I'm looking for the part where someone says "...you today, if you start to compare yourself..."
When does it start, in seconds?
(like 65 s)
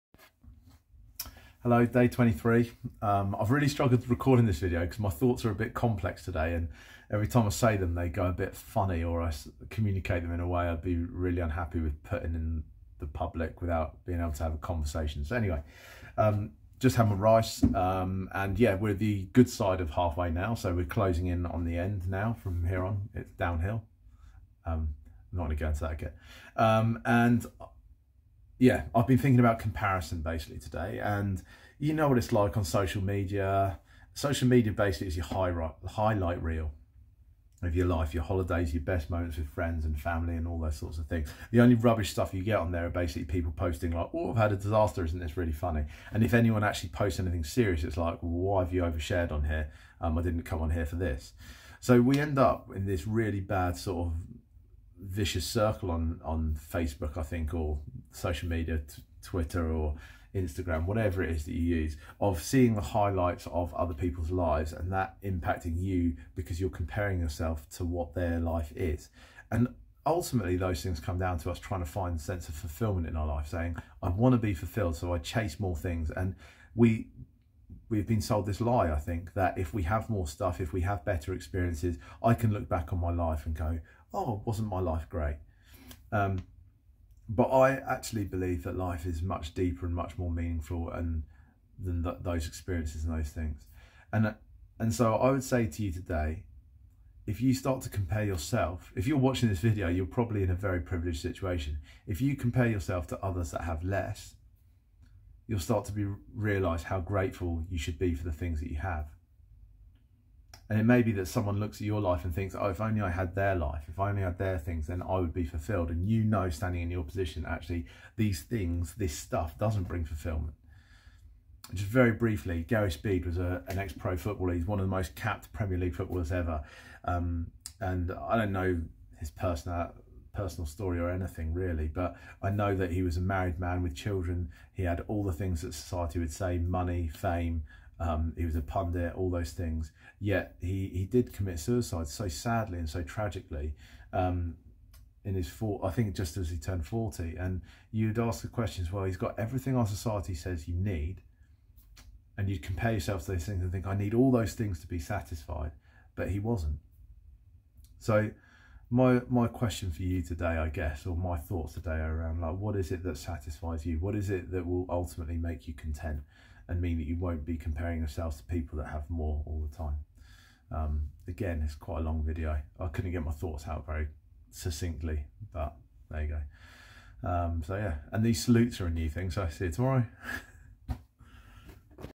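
95 s.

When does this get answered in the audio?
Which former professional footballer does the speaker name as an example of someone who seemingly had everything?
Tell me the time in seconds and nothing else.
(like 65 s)
122 s.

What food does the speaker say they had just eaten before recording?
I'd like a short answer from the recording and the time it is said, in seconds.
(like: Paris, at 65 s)
rice, at 17 s.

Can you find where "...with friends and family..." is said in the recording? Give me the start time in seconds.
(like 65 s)
39 s.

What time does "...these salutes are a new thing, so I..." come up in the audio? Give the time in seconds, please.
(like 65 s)
178 s.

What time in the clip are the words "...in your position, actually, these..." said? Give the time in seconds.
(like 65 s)
116 s.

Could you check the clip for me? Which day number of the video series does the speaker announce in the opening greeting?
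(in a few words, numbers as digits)
23.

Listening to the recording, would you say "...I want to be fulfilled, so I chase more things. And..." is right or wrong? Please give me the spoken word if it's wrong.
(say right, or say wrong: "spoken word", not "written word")
right.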